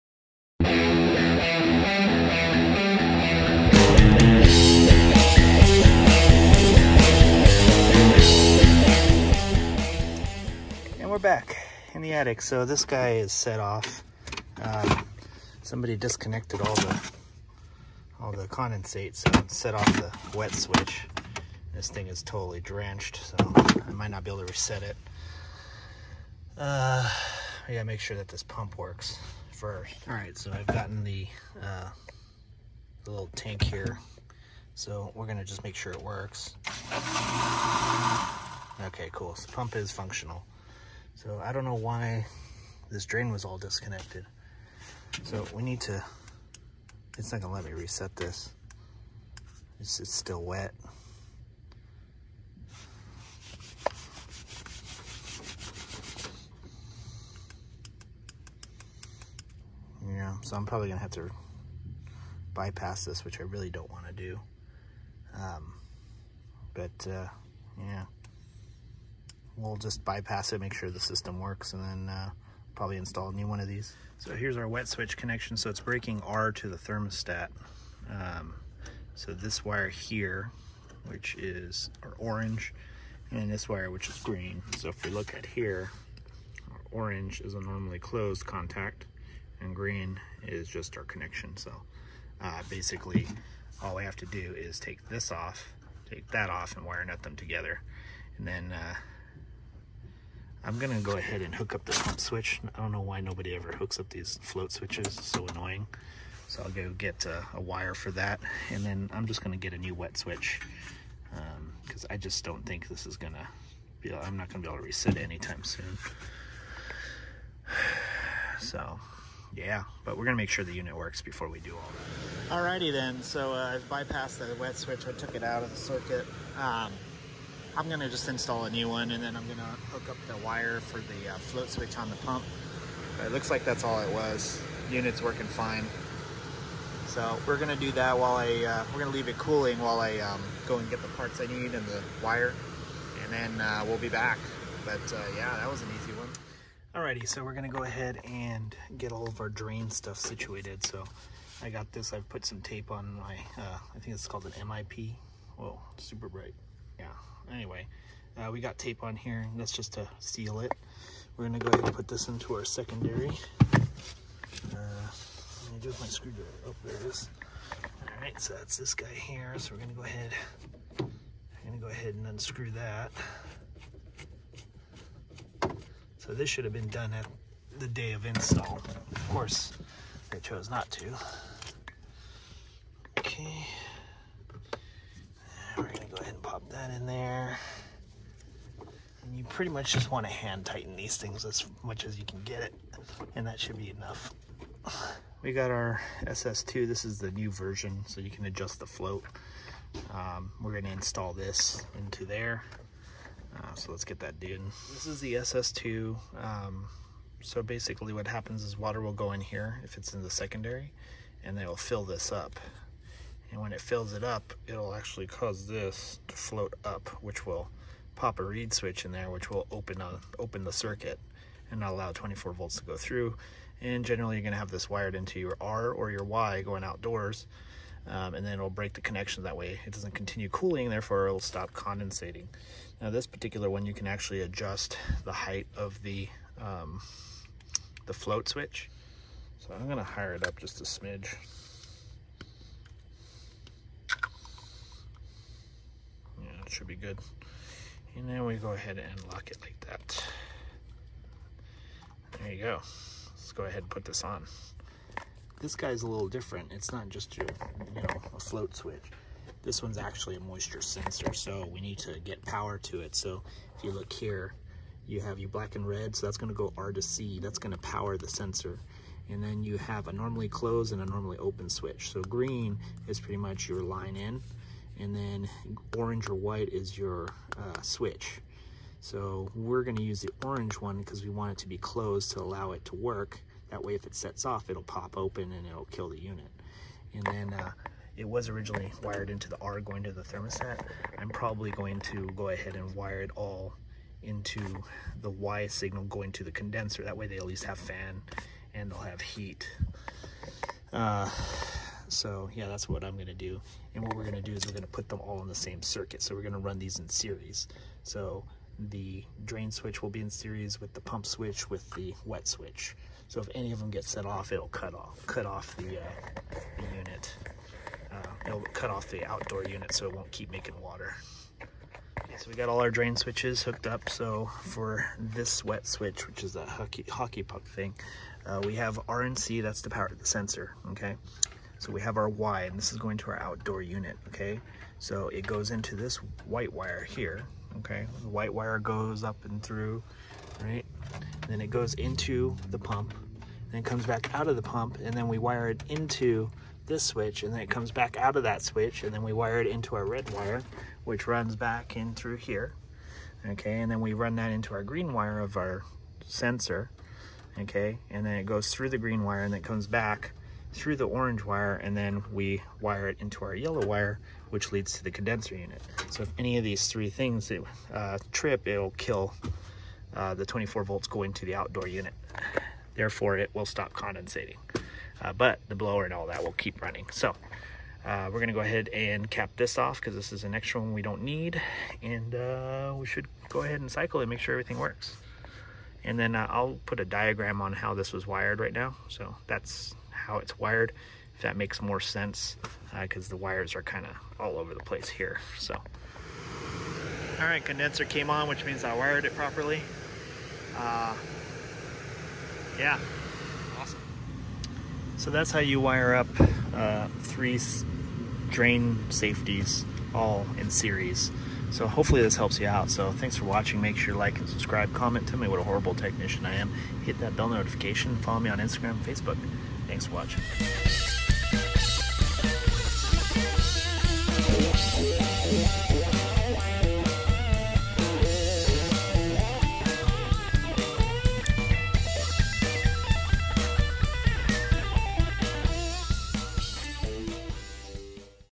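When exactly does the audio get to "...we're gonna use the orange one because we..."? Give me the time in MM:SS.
04:39.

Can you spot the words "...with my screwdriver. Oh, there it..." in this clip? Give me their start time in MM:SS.
02:45.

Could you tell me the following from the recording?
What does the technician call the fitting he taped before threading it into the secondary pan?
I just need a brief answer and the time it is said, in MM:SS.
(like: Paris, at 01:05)
MIP, at 02:34.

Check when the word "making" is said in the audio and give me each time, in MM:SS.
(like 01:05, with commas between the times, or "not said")
05:20.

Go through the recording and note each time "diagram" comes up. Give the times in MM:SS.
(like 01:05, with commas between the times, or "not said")
06:27.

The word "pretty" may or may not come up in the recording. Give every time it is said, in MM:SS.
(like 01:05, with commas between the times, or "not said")
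03:09, 04:33.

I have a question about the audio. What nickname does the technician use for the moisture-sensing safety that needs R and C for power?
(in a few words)
hockey puck.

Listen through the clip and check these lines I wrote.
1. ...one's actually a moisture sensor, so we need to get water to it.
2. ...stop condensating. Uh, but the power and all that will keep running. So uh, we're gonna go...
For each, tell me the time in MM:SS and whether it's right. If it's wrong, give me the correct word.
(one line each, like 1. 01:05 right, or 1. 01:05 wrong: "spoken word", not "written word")
1. 04:19 wrong: "power", not "water"
2. 06:13 wrong: "blower", not "power".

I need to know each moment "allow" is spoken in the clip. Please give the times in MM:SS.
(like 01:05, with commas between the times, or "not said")
03:41, 04:42.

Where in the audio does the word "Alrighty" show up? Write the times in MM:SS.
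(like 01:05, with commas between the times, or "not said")
02:02, 02:26.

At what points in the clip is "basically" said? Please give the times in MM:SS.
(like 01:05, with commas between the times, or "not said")
01:32, 03:27.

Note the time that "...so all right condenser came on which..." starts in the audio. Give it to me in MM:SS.
06:35.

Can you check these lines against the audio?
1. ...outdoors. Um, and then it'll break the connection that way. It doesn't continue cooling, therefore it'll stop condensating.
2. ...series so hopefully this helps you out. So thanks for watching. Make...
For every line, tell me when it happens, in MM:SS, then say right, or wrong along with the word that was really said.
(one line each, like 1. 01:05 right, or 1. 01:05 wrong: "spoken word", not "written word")
1. 03:46 right
2. 06:50 right.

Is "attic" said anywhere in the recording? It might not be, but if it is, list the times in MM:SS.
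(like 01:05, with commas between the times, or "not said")
00:12.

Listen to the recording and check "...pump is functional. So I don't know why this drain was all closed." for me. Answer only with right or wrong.
wrong.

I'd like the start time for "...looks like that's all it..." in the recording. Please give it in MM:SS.
02:13.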